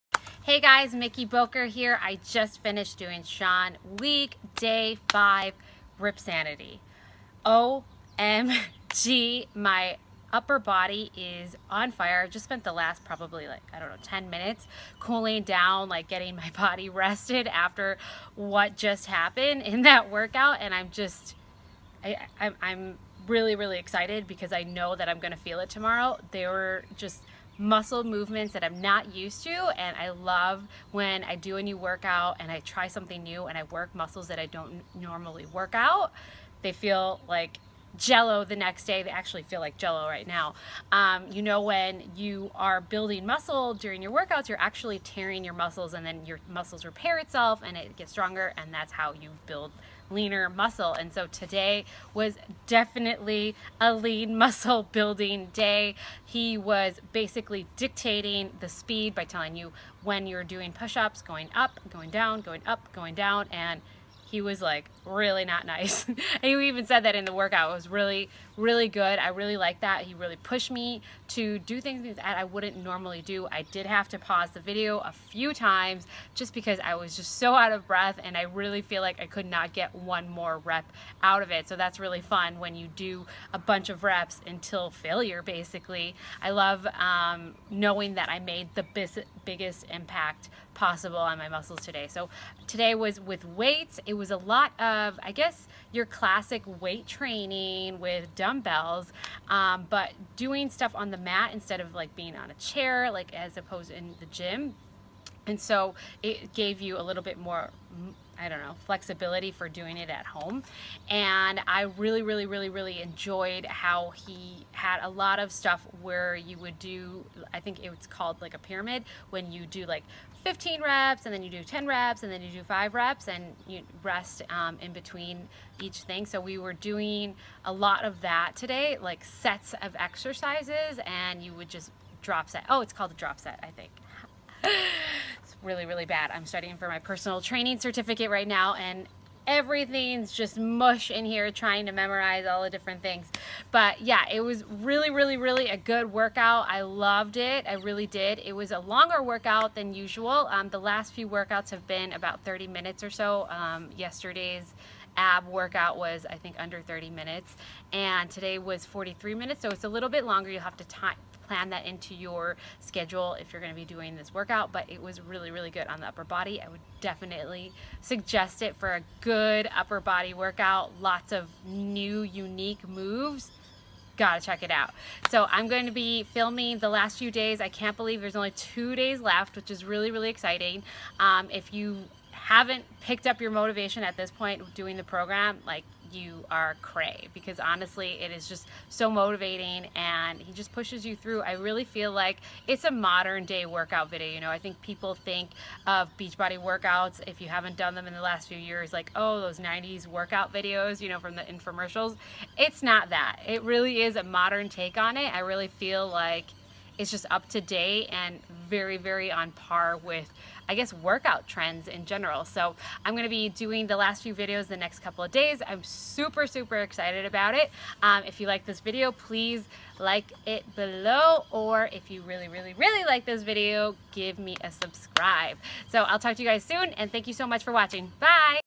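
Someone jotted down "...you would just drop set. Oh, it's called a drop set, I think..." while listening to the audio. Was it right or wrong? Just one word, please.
right.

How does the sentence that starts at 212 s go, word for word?
So I'm gonna be doing the last few videos the next couple of days.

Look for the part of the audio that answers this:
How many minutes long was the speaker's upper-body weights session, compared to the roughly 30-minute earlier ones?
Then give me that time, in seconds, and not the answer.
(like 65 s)
158 s.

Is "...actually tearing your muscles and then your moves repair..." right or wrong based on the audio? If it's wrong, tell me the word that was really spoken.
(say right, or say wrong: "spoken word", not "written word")
wrong: "muscles", not "moves".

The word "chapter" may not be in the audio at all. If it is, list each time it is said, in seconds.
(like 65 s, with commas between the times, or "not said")
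not said.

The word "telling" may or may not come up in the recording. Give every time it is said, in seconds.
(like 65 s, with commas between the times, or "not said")
59 s.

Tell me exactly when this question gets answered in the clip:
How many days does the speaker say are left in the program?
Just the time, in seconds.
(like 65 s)
178 s.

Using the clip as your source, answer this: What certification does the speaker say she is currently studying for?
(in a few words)
Personal training certificate.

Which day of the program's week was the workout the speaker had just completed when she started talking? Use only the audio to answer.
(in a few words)
Day 5.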